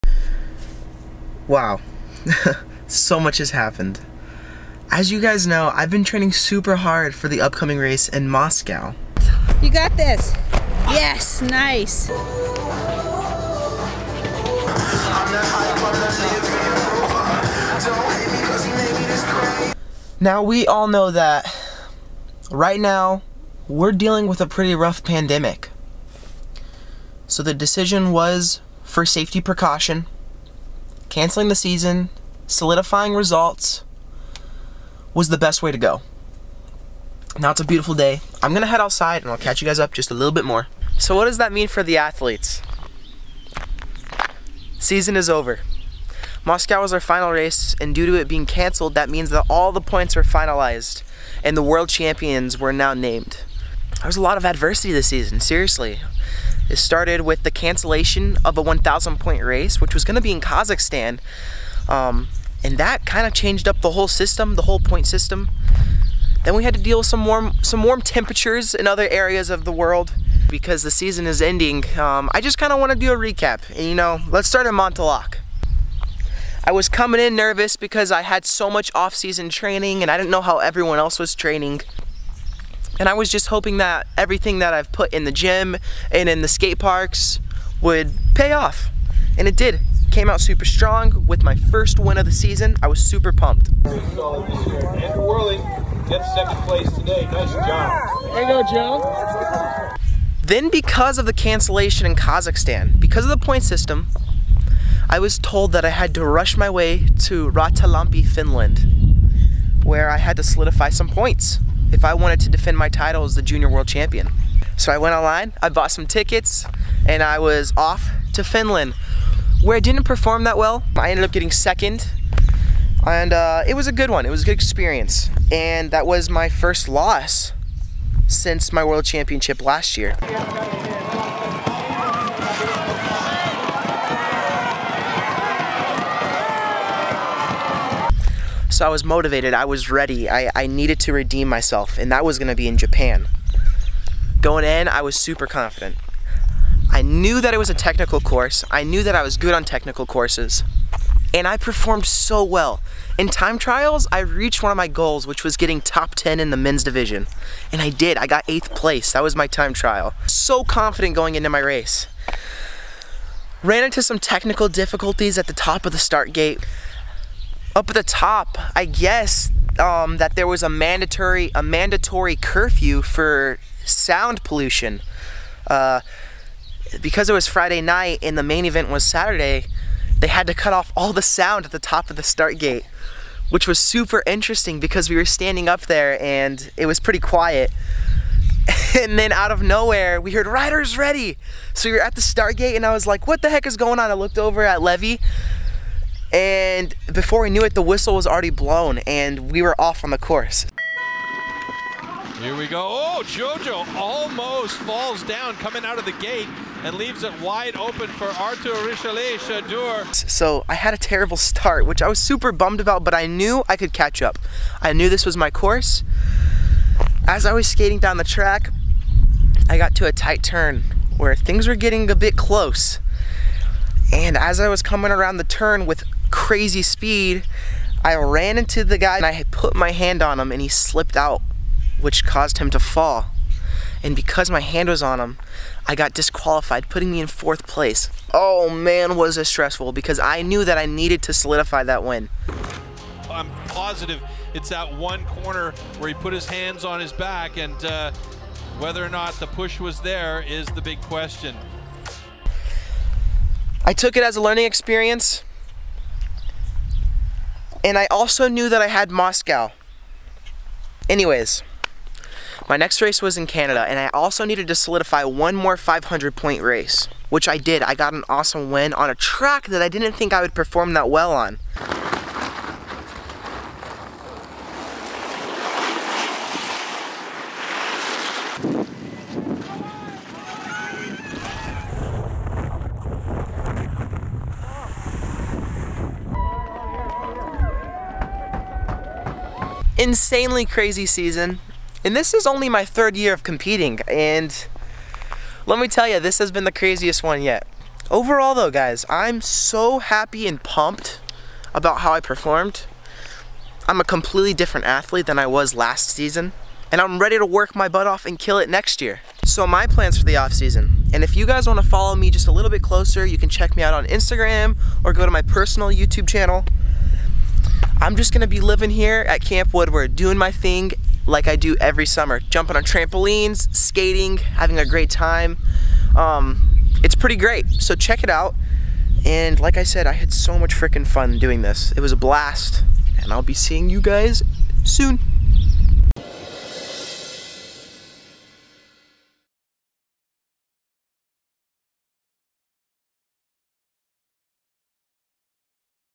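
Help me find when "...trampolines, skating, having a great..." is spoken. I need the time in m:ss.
5:22.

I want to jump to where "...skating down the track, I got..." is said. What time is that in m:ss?
3:37.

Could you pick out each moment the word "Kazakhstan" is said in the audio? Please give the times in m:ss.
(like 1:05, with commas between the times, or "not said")
1:00, 1:42.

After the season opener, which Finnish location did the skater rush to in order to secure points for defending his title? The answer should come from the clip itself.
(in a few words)
Rautalampi.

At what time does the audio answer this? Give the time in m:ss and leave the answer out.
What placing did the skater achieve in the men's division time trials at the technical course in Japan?
2:38.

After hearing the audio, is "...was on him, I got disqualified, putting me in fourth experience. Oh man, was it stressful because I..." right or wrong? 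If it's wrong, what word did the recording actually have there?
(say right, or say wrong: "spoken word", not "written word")
wrong: "place", not "experience".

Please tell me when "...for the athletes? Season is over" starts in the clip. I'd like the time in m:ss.
0:41.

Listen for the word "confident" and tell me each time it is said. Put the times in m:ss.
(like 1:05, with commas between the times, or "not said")
2:25, 2:40.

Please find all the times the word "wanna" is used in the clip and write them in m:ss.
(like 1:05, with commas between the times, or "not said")
5:11.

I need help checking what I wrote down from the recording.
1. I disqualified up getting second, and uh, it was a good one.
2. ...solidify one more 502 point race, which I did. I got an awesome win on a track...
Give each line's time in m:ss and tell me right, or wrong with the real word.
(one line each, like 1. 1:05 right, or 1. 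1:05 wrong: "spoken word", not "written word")
1. 2:00 wrong: "ended", not "disqualified"
2. 4:24 wrong: "500", not "502".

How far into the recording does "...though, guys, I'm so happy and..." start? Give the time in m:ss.
4:58.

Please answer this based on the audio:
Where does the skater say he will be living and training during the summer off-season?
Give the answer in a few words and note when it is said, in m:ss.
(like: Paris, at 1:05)
Camp Woodward, at 5:19.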